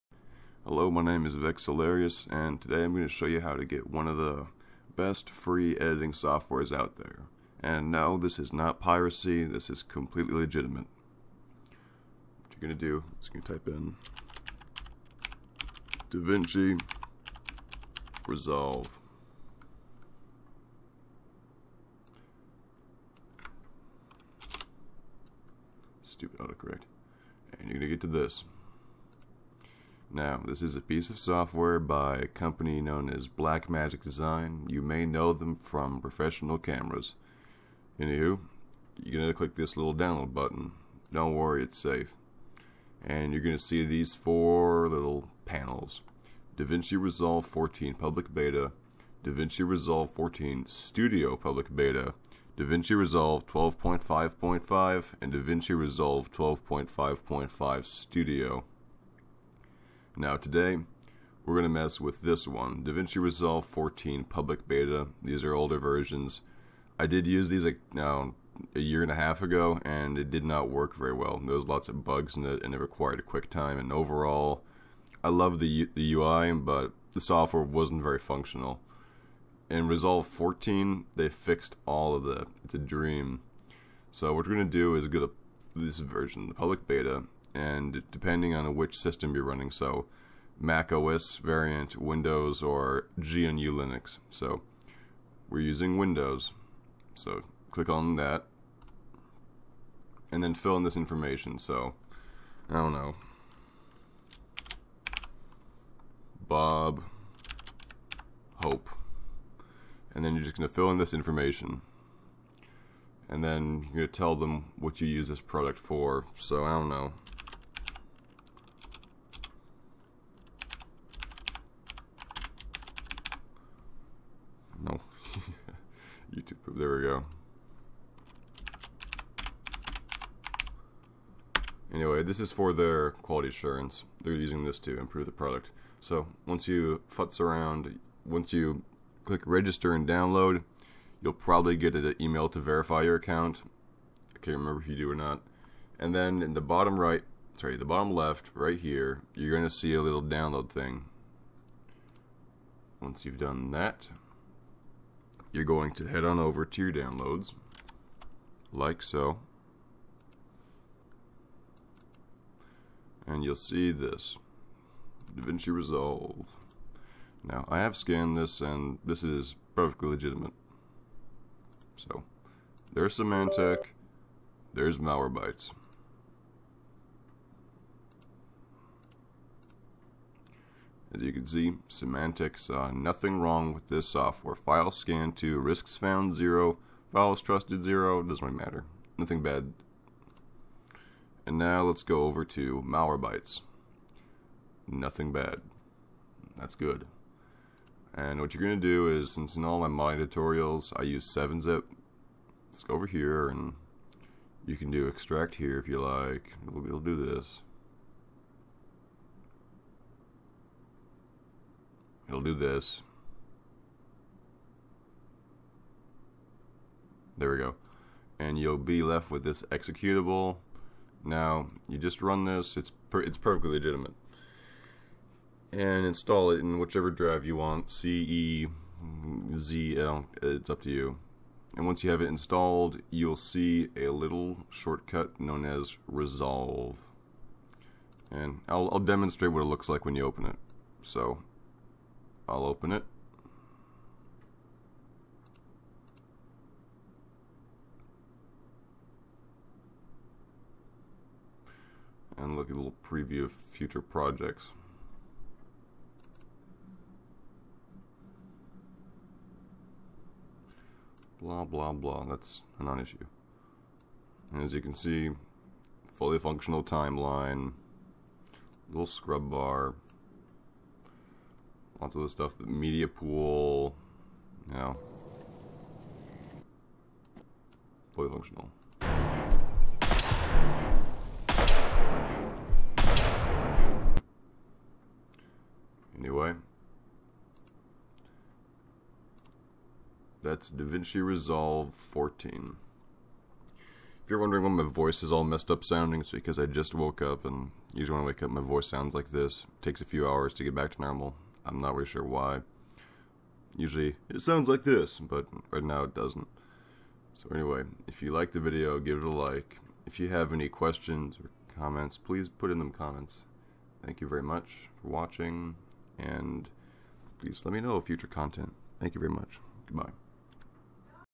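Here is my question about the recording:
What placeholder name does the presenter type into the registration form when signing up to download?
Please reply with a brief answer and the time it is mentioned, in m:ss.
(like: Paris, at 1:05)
Bob Hope, at 1:46.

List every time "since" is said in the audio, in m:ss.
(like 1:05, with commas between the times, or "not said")
3:19.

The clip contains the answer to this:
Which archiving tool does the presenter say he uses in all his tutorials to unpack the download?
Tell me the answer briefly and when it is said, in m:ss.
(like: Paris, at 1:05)
7-zip, at 3:21.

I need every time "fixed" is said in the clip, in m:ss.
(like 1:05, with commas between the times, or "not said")
1:21.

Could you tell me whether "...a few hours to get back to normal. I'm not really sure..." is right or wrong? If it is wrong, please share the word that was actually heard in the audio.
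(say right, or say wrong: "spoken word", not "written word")
right.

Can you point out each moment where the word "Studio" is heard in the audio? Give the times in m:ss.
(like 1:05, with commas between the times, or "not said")
0:50, 0:57.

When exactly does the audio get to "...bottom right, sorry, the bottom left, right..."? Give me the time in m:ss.
2:26.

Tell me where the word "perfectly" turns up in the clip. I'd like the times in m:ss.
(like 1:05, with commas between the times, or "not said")
2:49, 3:43.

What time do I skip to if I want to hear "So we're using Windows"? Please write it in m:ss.
1:34.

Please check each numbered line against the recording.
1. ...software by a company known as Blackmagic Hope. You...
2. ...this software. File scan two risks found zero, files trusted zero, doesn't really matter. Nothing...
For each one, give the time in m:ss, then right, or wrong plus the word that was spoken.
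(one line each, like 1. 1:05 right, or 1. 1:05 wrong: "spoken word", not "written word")
1. 0:31 wrong: "Design", not "Hope"
2. 3:03 right.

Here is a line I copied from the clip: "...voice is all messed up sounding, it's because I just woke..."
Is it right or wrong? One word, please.
right.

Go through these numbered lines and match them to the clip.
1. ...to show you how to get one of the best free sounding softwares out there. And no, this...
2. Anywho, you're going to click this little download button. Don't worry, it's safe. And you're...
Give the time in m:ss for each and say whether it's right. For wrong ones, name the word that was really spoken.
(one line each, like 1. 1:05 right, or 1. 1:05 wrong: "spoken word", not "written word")
1. 0:03 wrong: "editing", not "sounding"
2. 0:37 right.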